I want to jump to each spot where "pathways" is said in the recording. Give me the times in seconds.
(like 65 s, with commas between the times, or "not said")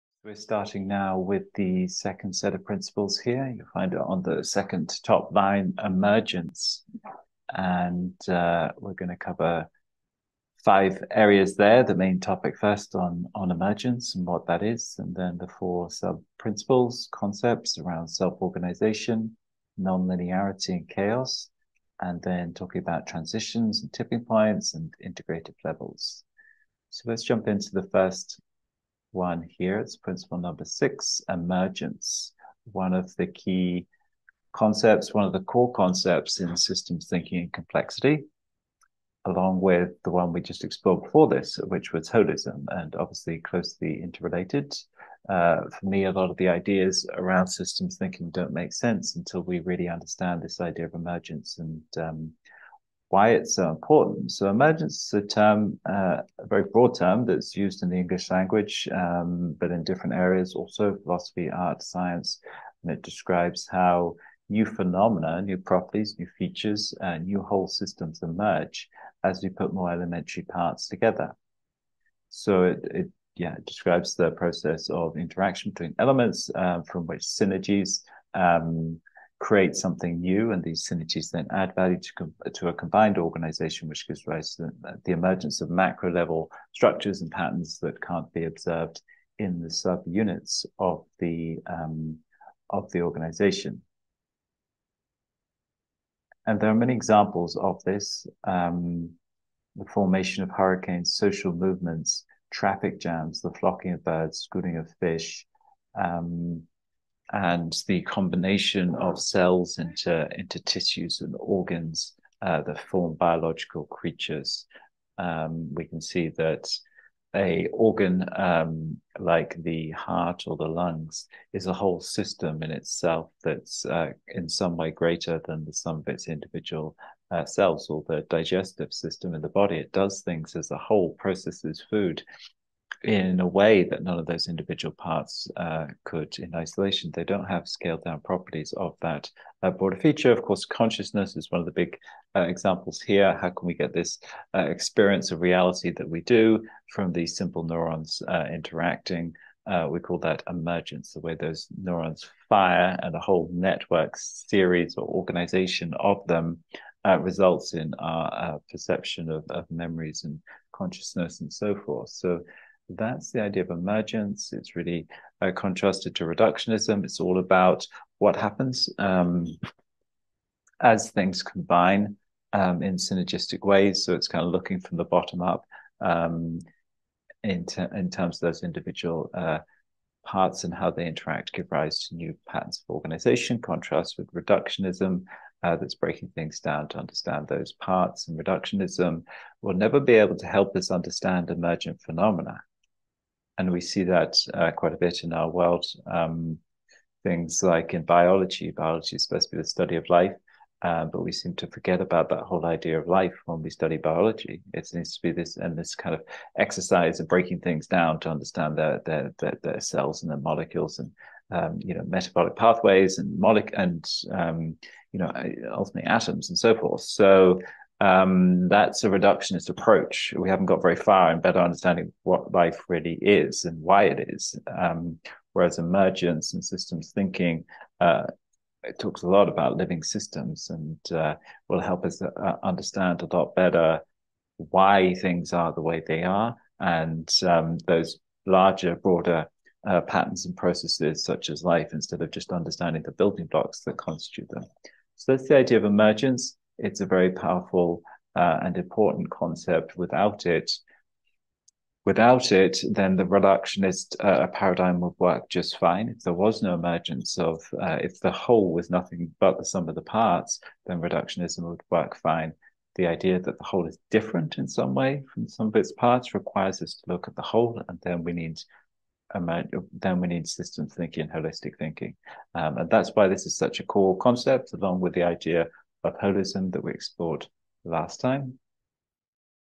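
212 s.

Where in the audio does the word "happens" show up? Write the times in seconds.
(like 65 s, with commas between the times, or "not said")
168 s.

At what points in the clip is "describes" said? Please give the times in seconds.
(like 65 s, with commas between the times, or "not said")
63 s, 73 s.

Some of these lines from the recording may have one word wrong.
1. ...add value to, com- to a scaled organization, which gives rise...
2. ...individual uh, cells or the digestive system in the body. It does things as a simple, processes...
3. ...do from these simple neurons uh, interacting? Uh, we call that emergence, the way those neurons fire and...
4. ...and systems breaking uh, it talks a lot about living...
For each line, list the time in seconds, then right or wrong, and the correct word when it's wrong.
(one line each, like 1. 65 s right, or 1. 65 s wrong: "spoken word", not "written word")
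1. 81 s wrong: "combined", not "scaled"
2. 126 s wrong: "whole", not "simple"
3. 146 s right
4. 226 s wrong: "thinking", not "breaking".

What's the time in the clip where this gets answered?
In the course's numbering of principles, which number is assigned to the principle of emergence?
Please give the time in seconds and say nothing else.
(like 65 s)
30 s.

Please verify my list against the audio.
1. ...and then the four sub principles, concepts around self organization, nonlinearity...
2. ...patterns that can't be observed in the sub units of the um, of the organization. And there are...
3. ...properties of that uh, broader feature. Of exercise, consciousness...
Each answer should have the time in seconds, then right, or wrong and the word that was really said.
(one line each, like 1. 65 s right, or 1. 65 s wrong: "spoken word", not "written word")
1. 14 s right
2. 87 s right
3. 138 s wrong: "course", not "exercise".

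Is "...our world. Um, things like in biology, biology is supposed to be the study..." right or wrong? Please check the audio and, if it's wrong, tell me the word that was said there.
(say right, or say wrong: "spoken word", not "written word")
right.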